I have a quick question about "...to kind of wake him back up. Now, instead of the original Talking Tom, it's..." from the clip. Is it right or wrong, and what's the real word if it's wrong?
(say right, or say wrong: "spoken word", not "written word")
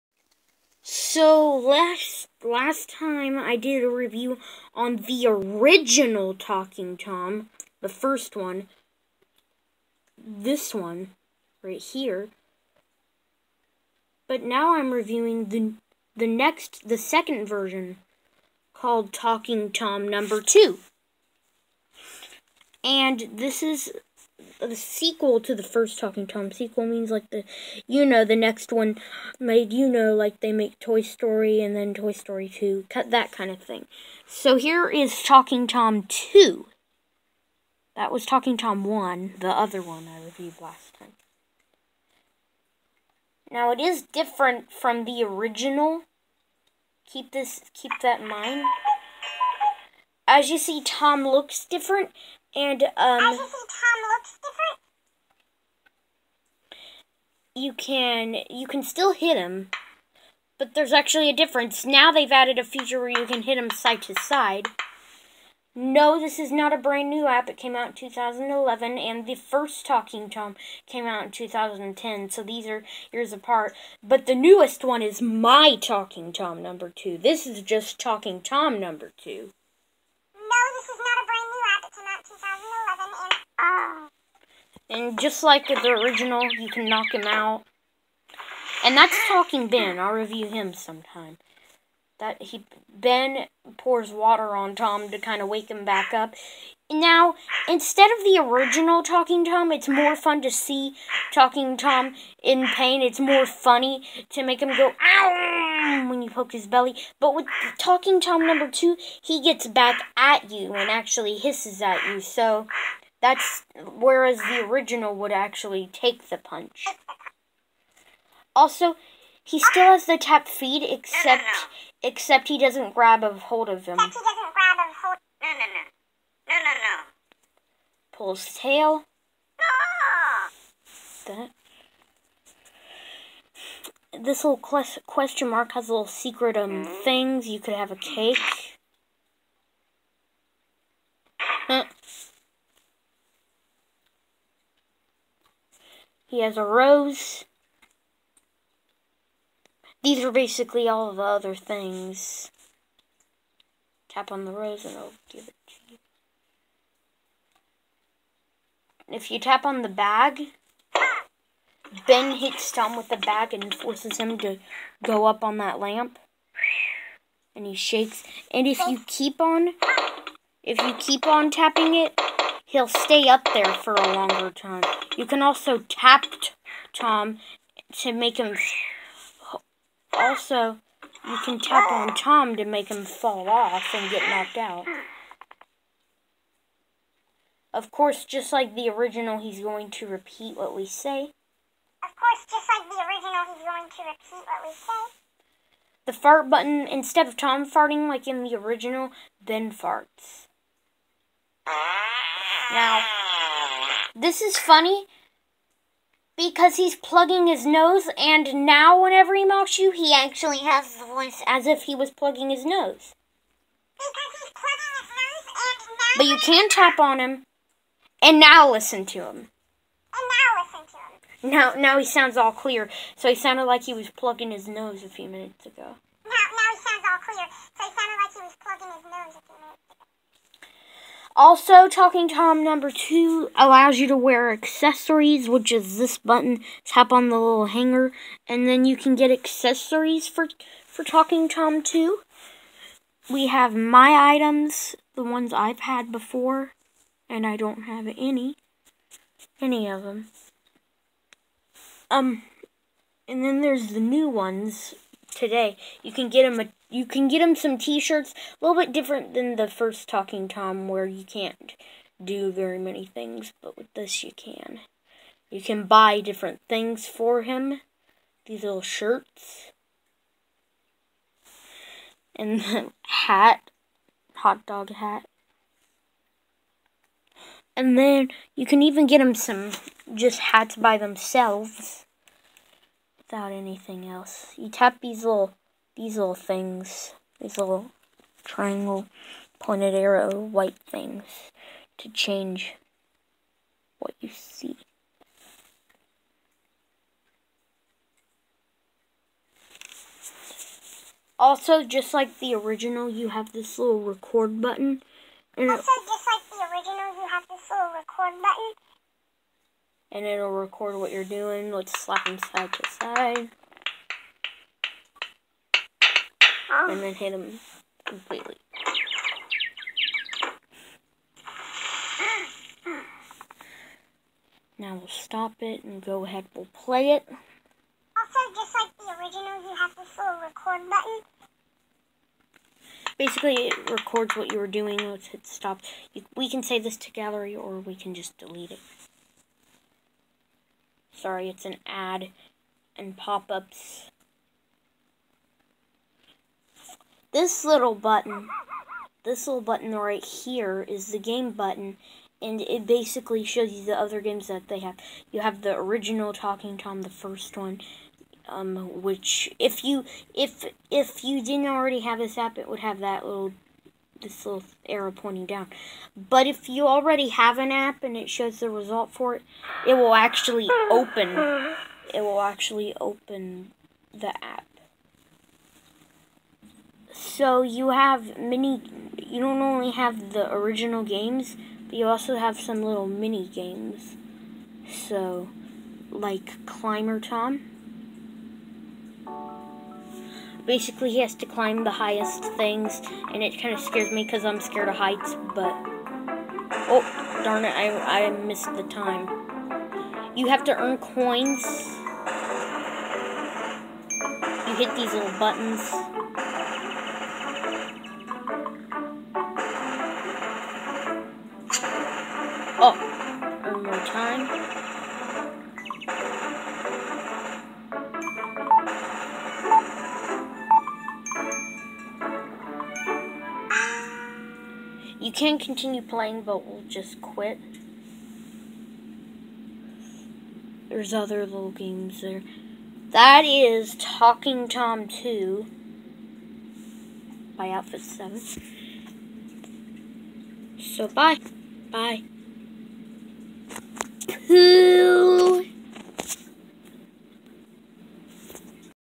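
right.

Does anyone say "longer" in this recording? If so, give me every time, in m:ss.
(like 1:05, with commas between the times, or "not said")
2:54.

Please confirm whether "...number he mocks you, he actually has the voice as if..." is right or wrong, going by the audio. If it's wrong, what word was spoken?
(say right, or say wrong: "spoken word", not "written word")
wrong: "whenever", not "number".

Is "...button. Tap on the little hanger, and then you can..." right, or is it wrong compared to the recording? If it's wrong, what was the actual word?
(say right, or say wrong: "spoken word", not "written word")
right.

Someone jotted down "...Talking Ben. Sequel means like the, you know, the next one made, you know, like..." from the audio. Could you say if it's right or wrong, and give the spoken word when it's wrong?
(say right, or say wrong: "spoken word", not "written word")
wrong: "Tom", not "Ben".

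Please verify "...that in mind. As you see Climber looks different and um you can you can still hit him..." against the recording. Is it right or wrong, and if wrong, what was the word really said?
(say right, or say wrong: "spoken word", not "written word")
wrong: "Tom", not "Climber".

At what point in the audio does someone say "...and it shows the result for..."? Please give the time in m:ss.
6:08.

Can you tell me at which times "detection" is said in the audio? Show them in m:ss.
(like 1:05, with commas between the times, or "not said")
not said.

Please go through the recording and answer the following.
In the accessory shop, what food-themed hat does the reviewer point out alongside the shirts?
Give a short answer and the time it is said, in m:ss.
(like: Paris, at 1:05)
Hot dog hat, at 4:34.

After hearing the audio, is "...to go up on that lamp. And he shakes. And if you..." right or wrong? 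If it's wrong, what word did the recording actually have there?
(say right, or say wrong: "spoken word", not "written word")
right.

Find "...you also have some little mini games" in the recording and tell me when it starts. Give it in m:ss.
6:21.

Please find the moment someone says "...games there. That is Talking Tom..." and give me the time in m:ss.
7:11.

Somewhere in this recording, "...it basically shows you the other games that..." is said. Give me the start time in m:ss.
5:52.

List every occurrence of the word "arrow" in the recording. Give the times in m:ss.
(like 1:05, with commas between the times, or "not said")
4:49, 6:04.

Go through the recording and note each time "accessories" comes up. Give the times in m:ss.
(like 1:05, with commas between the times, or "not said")
3:54, 3:59.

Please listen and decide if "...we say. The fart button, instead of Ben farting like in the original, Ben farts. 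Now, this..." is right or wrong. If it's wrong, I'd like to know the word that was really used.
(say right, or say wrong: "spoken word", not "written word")
wrong: "Tom", not "Ben".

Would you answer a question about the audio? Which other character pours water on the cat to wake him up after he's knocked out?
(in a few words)
Talking Ben.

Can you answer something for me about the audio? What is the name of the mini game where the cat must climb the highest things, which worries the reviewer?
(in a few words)
Climber Tom.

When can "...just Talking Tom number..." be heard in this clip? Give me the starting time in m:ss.
1:17.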